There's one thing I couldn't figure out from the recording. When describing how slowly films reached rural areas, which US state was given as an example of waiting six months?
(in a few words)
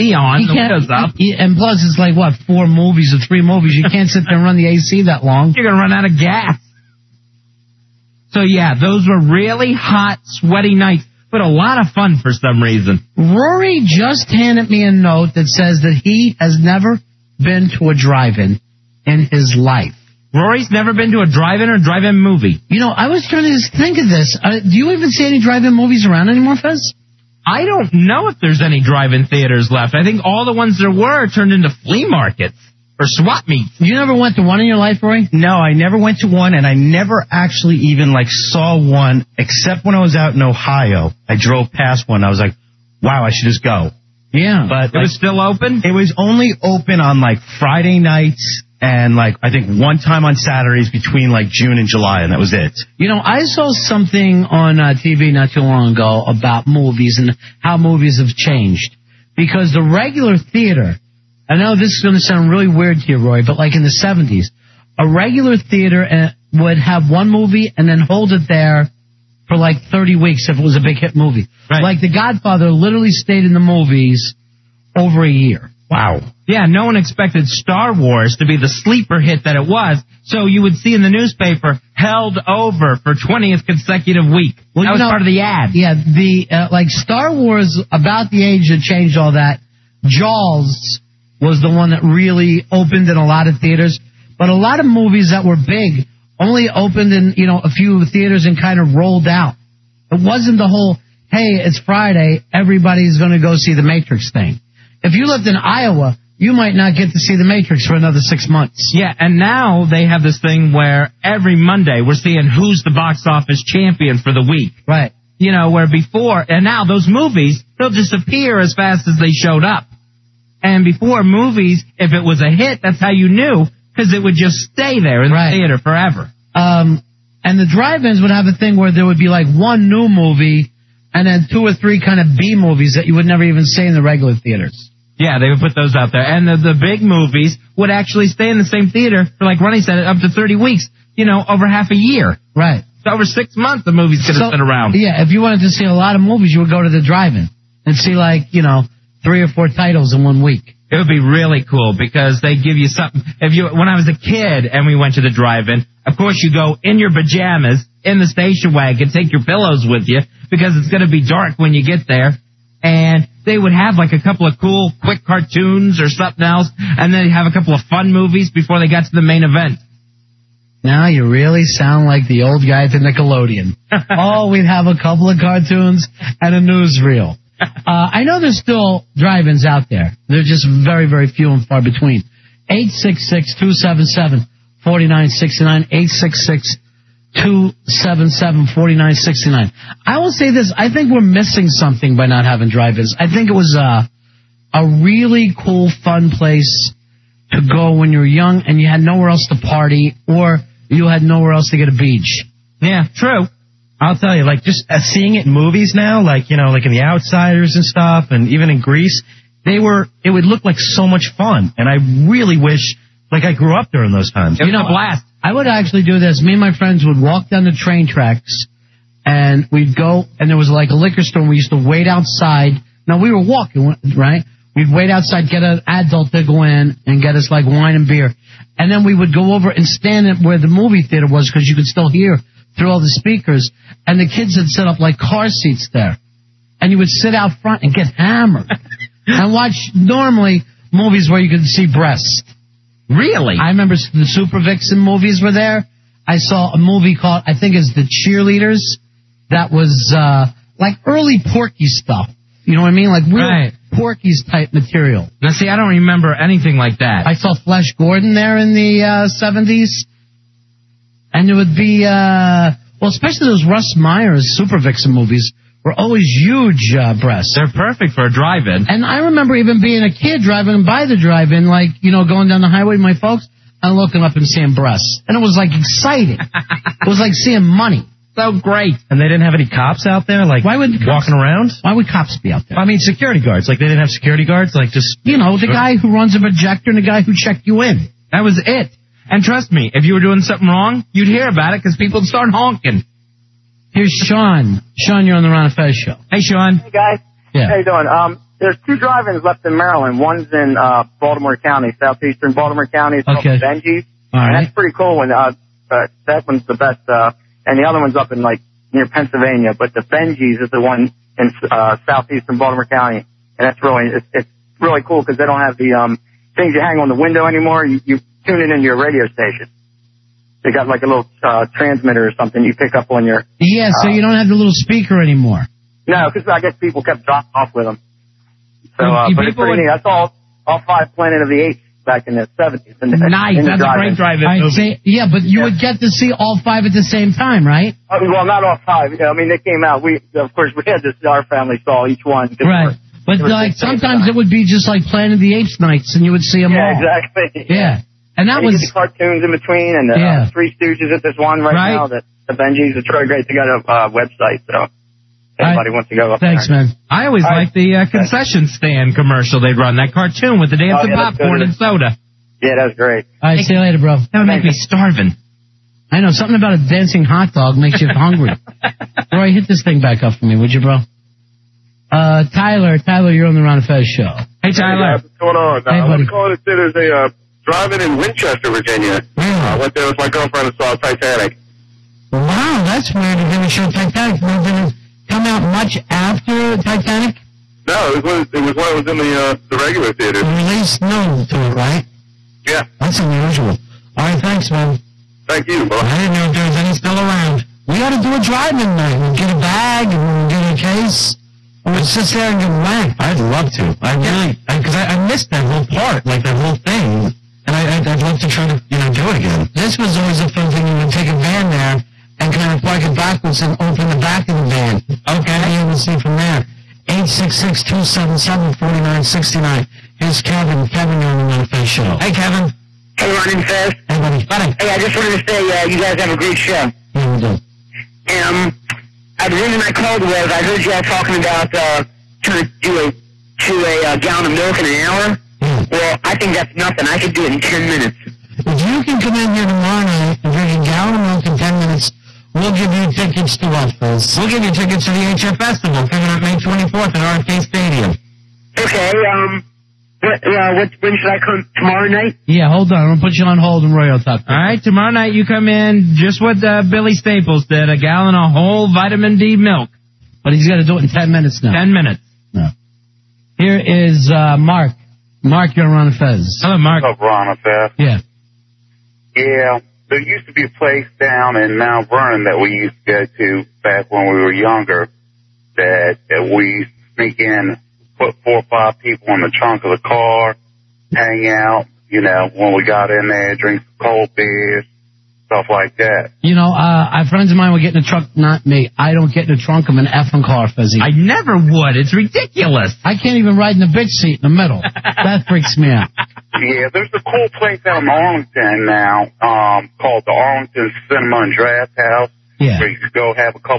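Iowa.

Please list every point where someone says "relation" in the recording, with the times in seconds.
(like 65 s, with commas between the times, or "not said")
not said.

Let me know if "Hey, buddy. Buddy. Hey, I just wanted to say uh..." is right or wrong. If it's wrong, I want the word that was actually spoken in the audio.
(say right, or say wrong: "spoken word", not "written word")
right.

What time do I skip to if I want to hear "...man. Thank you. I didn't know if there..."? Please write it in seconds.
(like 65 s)
394 s.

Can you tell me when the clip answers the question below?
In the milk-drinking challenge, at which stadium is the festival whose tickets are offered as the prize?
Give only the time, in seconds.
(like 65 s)
447 s.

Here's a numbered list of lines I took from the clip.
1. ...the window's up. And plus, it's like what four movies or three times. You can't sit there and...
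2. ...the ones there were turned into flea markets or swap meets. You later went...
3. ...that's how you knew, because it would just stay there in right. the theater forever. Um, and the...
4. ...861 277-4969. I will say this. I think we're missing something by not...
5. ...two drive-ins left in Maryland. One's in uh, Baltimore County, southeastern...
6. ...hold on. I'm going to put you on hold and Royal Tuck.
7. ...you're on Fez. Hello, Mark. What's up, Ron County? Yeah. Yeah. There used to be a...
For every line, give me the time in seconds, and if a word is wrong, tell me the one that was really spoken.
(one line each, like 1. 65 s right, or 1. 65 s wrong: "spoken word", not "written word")
1. 0 s wrong: "movies", not "times"
2. 30 s wrong: "never", not "later"
3. 122 s right
4. 185 s wrong: "866", not "861"
5. 298 s right
6. 452 s right
7. 465 s wrong: "Fez", not "County".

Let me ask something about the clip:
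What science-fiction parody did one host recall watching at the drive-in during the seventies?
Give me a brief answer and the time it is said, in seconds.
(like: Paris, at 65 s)
Flesh Gordon, at 257 s.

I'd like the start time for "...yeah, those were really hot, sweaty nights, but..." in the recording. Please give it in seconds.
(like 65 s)
8 s.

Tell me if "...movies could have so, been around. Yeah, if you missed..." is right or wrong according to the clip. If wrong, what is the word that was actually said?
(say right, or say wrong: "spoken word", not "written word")
wrong: "wanted", not "missed".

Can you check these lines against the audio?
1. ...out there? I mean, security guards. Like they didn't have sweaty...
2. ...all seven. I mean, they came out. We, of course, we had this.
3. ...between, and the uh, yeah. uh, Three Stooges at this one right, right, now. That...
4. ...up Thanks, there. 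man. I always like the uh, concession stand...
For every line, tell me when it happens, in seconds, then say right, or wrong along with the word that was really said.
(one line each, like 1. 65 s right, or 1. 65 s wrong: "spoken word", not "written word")
1. 282 s wrong: "security", not "sweaty"
2. 338 s wrong: "five", not "seven"
3. 349 s right
4. 356 s right.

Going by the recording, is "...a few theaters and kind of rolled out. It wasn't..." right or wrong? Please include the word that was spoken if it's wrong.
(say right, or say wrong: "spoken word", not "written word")
right.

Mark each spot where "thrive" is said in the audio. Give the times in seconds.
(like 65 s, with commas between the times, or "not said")
not said.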